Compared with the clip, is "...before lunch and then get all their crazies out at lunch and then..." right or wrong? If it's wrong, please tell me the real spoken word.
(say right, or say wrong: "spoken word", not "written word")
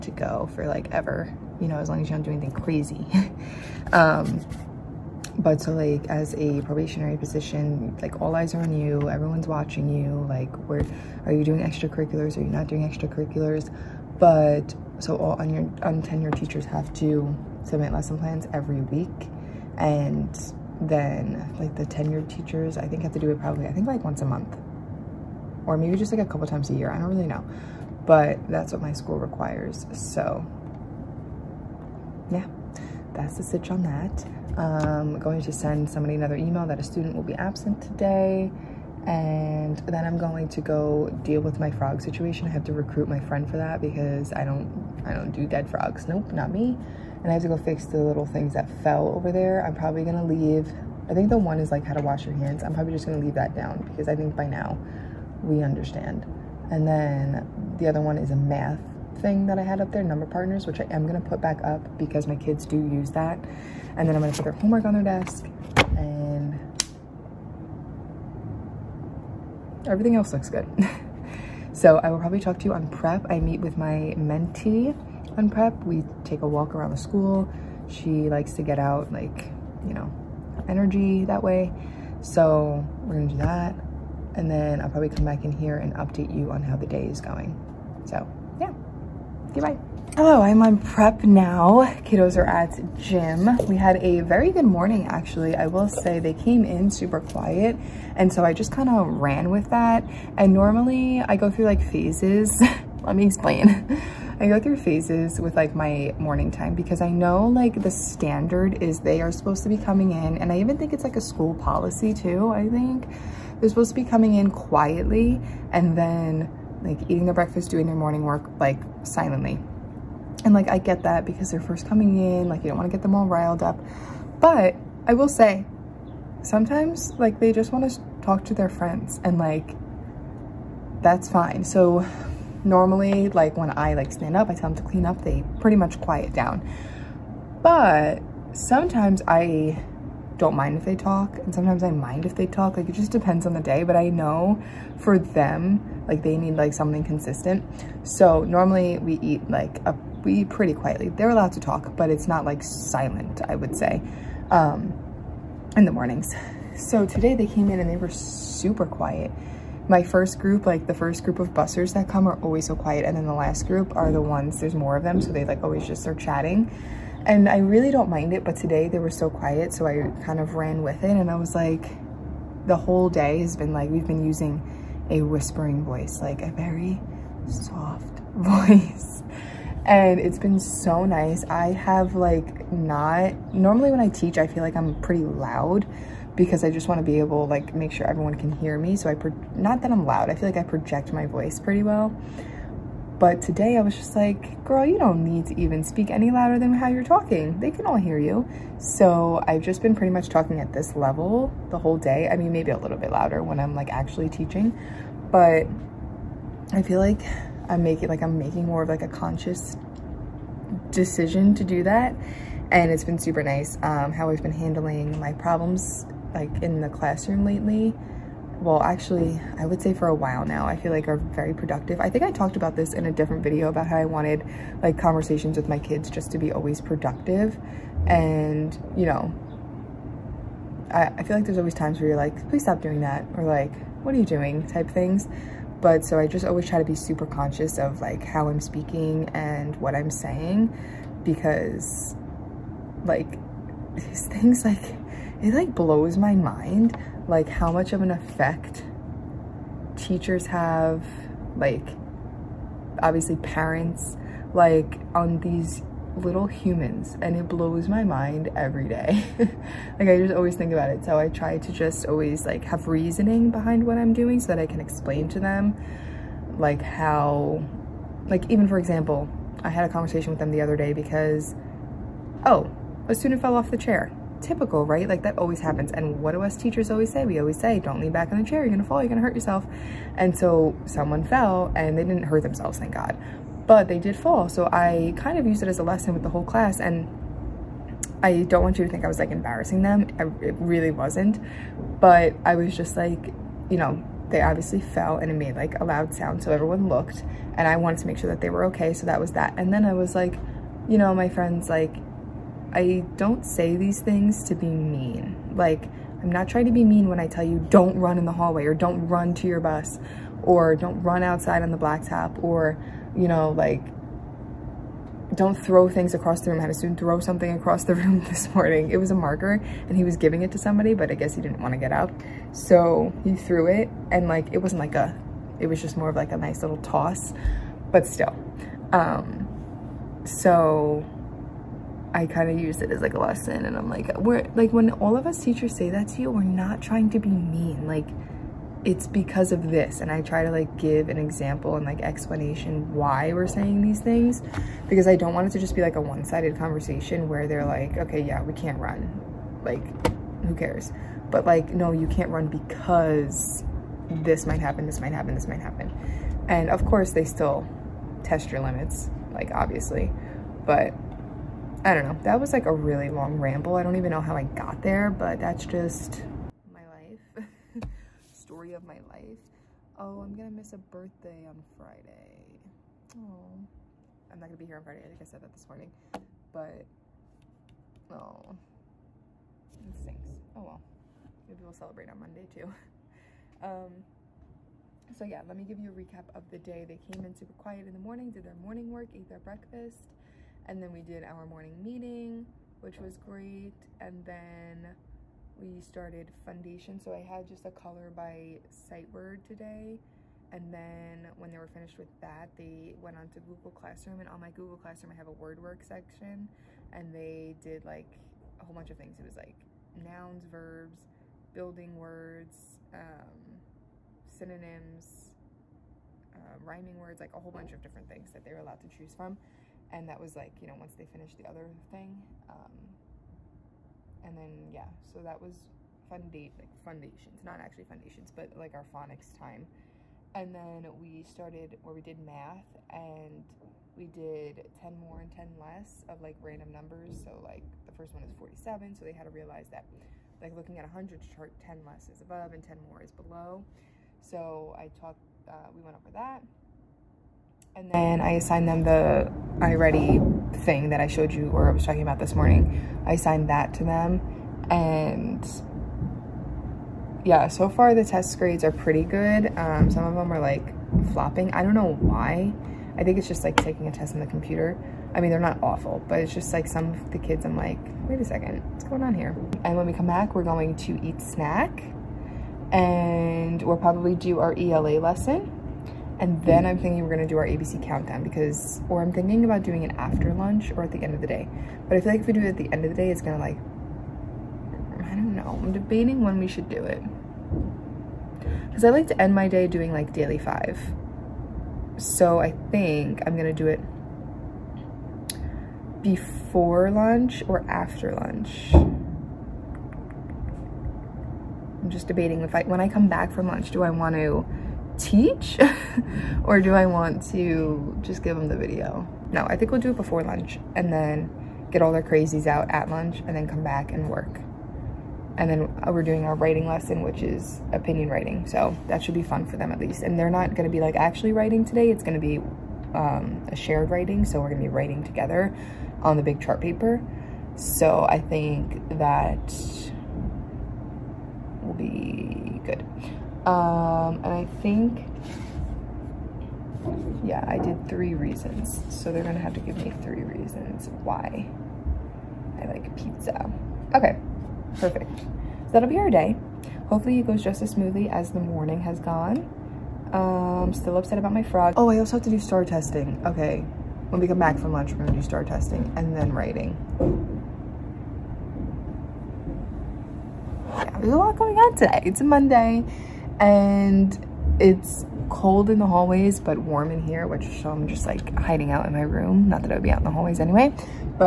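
right.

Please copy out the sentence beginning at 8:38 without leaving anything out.
So that should be fun for them at least.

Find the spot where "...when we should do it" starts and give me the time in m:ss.
8:06.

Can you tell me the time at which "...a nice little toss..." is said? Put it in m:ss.
5:26.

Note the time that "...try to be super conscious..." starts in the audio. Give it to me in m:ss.
3:56.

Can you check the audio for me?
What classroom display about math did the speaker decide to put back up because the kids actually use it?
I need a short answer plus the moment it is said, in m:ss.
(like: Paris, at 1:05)
Number partners, at 1:00.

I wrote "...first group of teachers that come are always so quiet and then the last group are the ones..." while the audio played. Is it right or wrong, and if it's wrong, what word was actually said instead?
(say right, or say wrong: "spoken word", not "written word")
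wrong: "busters", not "teachers".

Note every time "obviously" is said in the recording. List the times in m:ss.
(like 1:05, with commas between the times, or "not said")
4:13, 4:54, 5:59.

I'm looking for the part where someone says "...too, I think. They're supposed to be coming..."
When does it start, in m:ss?
1:52.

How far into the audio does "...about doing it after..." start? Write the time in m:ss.
7:59.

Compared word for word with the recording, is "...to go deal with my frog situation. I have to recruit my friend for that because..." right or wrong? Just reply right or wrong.
right.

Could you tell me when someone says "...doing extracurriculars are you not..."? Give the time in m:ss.
0:11.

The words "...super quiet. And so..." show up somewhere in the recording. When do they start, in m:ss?
1:36.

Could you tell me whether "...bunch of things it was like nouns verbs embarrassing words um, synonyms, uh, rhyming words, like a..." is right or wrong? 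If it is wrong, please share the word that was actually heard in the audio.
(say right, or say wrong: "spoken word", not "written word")
wrong: "building", not "embarrassing".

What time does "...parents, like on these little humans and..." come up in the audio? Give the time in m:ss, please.
4:13.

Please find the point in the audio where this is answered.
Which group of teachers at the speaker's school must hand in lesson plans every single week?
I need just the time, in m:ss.
0:15.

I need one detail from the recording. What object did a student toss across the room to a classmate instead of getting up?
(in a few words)
A marker.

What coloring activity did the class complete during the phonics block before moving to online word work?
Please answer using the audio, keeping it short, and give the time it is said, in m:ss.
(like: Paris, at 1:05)
Color by sight word, at 6:37.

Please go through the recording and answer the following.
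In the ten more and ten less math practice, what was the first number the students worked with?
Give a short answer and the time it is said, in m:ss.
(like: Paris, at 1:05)
47, at 7:18.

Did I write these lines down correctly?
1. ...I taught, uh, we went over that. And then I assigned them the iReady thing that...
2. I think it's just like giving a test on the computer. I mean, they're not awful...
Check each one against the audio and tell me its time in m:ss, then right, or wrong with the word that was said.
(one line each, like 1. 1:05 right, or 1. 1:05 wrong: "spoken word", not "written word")
1. 7:24 right
2. 7:42 wrong: "taking", not "giving".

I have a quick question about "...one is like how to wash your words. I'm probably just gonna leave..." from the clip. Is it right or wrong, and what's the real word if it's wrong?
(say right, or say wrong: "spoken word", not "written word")
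wrong: "hands", not "words".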